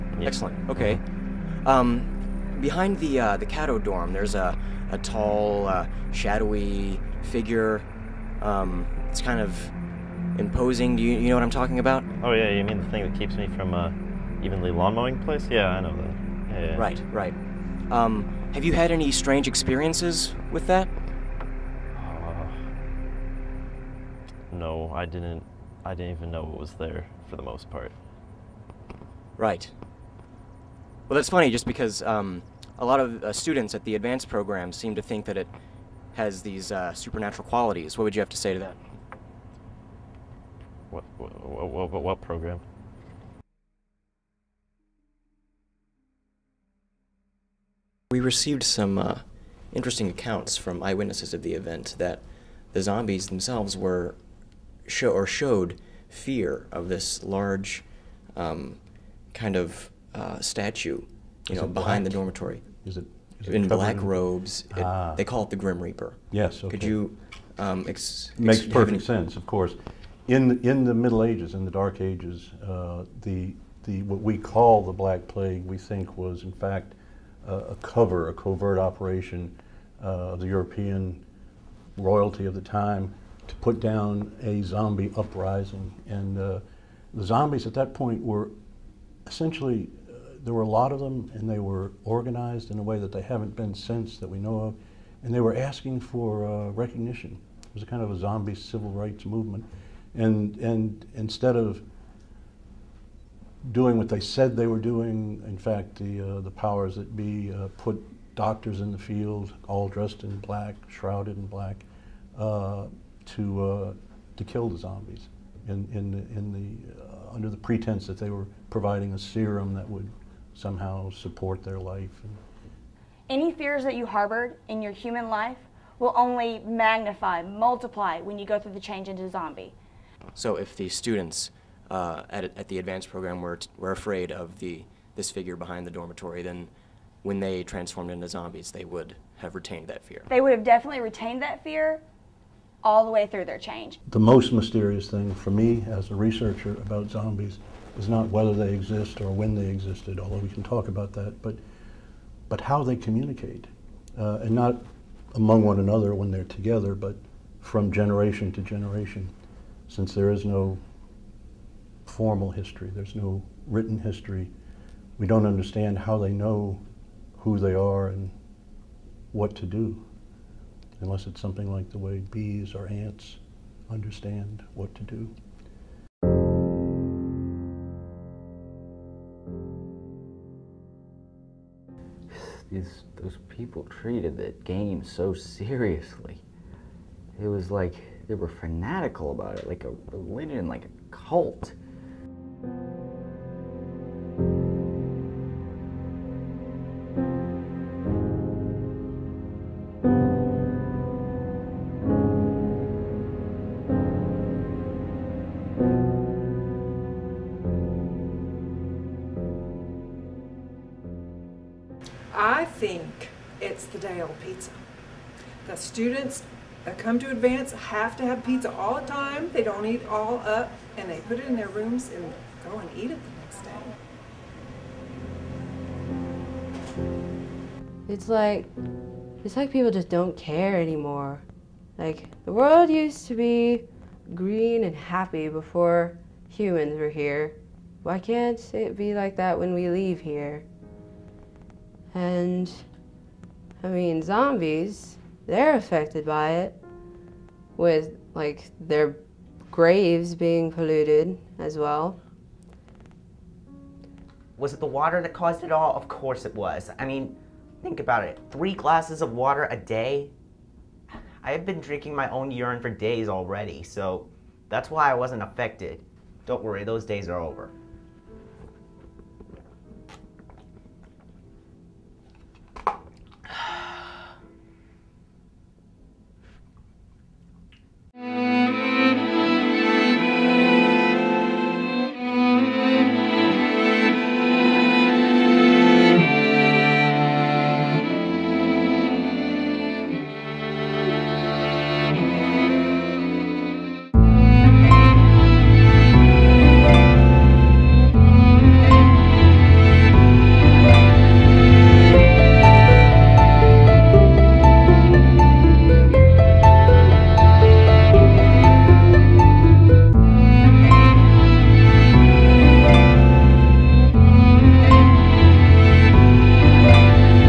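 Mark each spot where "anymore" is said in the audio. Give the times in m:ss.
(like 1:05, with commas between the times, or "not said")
3:50.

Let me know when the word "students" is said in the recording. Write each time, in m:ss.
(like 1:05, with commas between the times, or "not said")
0:33, 2:10, 3:35.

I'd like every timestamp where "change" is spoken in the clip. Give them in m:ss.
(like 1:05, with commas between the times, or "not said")
2:08, 2:23.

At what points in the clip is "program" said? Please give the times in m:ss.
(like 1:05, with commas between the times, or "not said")
0:34, 0:42, 2:13.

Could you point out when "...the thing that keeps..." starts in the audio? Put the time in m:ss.
0:12.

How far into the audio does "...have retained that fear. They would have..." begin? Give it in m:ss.
2:19.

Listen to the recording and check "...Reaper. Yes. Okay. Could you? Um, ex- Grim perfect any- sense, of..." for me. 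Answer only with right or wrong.
wrong.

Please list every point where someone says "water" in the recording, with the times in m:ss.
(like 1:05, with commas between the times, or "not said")
4:14, 4:19.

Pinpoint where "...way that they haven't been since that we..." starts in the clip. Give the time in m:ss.
1:32.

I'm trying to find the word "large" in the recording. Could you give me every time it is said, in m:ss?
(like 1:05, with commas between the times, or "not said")
0:57.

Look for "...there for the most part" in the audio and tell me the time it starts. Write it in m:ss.
0:26.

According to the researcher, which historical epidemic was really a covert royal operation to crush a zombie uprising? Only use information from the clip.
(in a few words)
Black Plague.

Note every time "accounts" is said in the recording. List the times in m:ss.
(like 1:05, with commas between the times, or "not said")
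0:50.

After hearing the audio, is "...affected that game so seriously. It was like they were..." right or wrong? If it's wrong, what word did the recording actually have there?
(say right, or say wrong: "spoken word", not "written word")
wrong: "treated", not "affected".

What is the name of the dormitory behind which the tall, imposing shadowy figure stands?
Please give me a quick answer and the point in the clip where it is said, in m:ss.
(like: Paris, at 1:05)
Cato, at 0:03.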